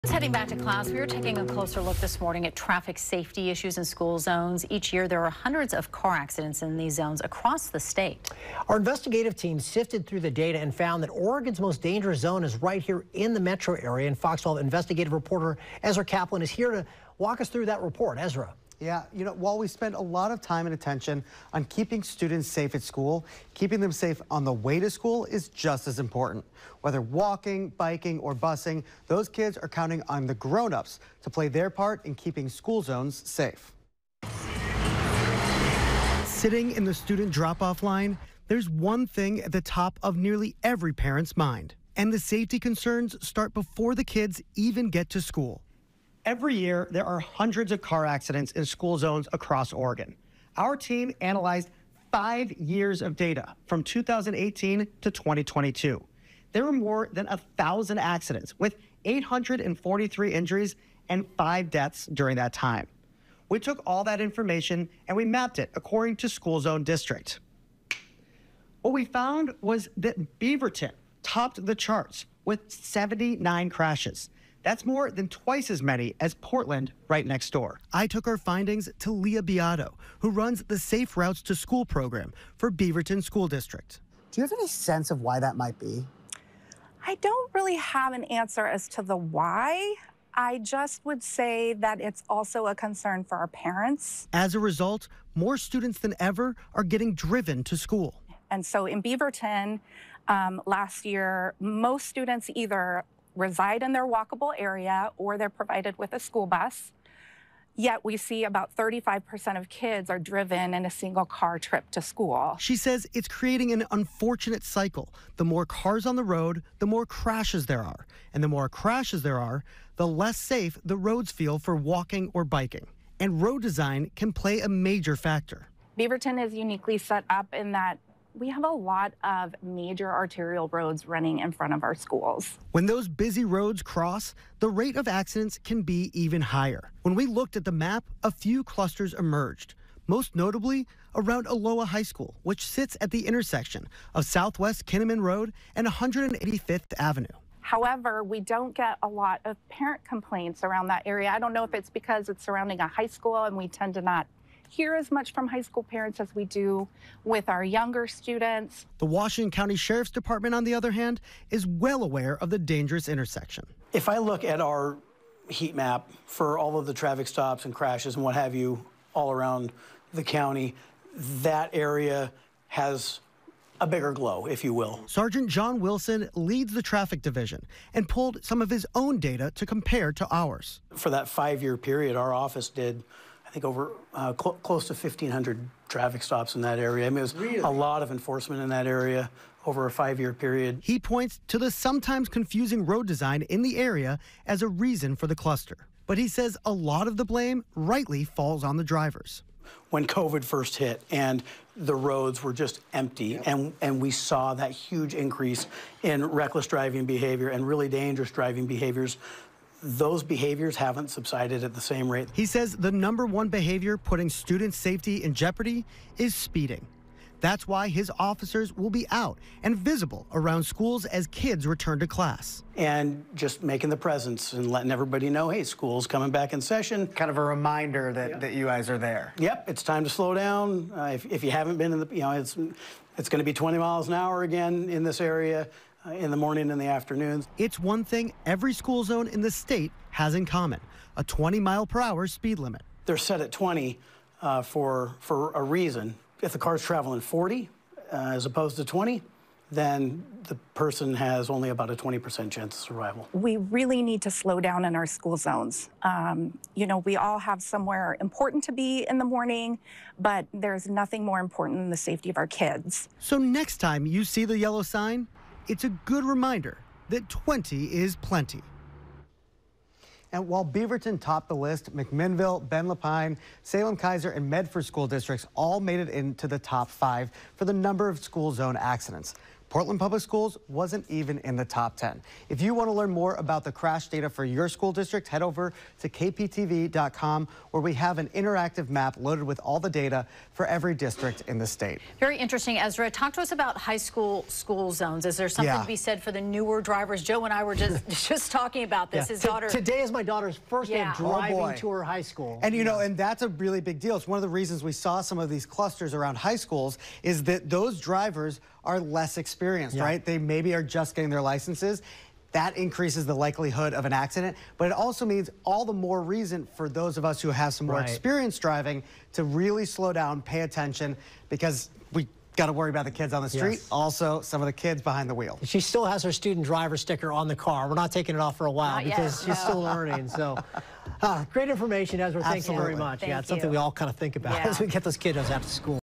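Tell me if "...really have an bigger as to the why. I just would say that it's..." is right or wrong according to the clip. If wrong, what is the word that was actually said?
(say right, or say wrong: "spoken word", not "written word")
wrong: "answer", not "bigger".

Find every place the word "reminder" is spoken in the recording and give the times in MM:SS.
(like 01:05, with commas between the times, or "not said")
03:47, 04:26.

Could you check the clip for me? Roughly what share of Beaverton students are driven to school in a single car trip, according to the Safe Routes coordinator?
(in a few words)
35%.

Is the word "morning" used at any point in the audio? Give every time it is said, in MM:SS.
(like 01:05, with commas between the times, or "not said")
00:02, 03:56, 04:19.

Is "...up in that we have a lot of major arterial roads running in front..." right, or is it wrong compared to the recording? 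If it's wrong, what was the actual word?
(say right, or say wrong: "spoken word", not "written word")
right.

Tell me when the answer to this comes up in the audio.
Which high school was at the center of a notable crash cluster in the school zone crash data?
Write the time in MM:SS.
02:21.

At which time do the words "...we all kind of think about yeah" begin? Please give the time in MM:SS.
05:33.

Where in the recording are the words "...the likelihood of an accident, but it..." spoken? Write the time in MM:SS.
05:13.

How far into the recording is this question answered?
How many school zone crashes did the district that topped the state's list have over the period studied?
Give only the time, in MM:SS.
01:12.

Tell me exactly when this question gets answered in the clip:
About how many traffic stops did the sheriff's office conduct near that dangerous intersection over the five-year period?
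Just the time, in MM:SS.
03:04.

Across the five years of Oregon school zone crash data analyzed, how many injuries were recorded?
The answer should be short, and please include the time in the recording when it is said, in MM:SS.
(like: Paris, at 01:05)
843, at 00:59.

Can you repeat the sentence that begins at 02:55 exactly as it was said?
Sergeant John Wilson leads the traffic division and pulled some of his own data to compare to ours.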